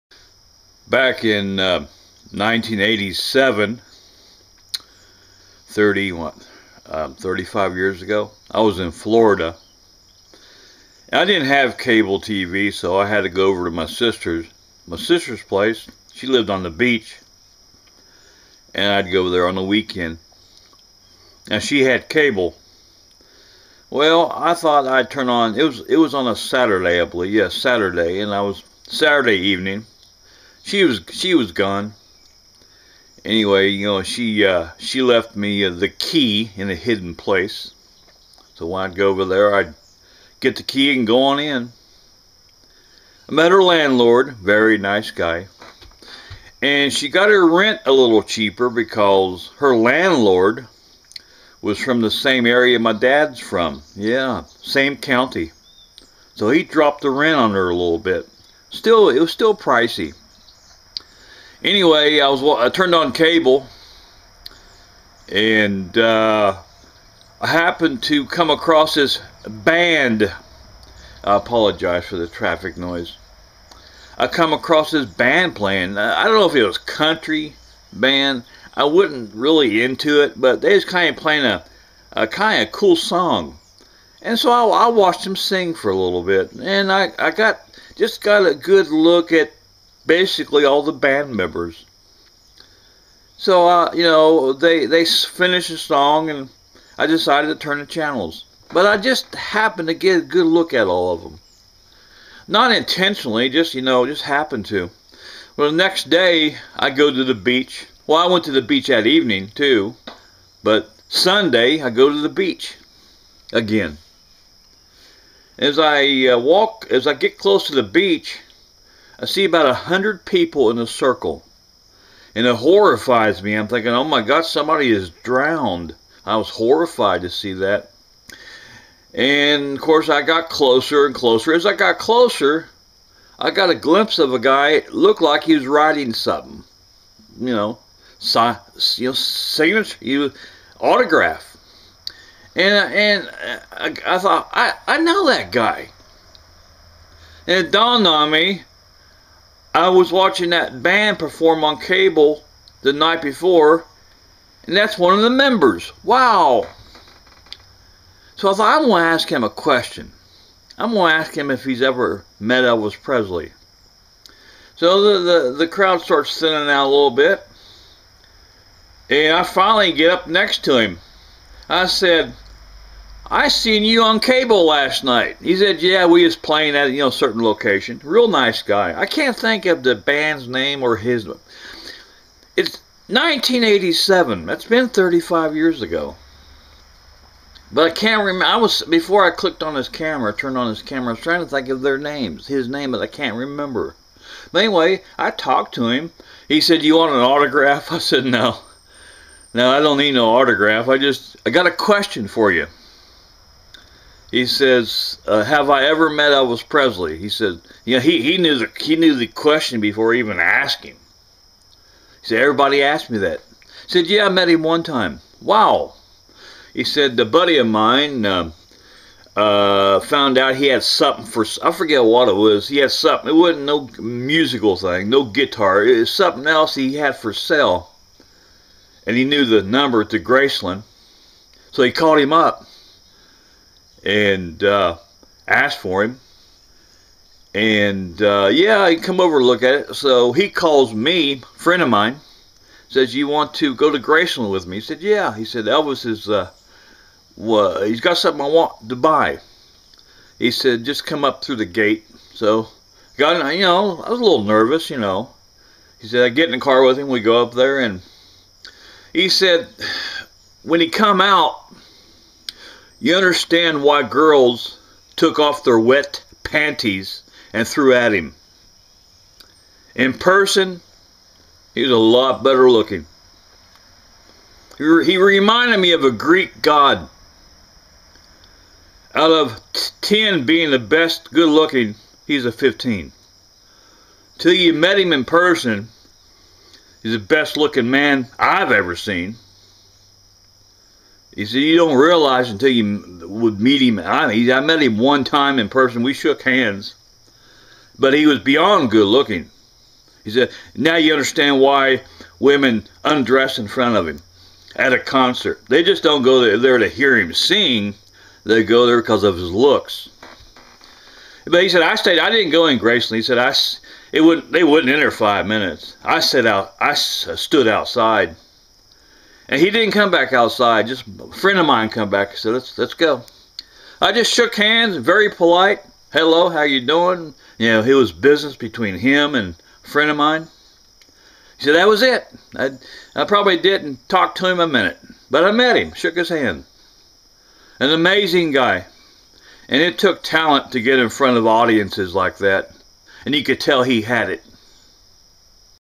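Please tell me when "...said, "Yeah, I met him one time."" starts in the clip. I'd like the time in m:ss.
3:33.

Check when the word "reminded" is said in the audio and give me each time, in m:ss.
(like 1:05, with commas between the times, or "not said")
4:35.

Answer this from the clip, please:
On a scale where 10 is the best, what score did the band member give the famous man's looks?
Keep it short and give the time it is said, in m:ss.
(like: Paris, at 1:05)
15, at 4:42.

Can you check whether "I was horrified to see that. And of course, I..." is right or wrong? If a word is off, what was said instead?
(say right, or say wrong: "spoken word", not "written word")
right.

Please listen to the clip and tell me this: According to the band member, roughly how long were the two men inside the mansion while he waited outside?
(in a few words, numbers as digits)
5 minutes.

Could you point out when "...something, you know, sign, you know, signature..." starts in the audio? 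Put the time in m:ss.
2:16.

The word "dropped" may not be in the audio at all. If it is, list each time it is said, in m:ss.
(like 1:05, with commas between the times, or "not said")
0:56.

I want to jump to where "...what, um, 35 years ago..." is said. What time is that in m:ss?
0:06.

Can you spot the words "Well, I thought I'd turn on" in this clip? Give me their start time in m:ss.
0:23.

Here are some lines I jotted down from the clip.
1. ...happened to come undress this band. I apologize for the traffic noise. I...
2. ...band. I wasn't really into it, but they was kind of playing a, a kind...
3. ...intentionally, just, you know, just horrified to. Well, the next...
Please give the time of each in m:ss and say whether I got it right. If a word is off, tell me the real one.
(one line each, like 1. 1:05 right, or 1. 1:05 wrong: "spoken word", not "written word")
1. 1:07 wrong: "across", not "undress"
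2. 1:17 right
3. 1:42 wrong: "happened", not "horrified".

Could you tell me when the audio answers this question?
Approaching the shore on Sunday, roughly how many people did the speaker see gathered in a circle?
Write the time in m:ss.
1:59.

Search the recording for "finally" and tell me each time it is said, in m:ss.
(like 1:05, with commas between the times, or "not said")
2:49.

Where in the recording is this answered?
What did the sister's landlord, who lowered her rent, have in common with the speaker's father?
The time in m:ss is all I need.
0:54.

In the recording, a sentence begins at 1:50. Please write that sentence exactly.
But Sunday, I go to the beach again.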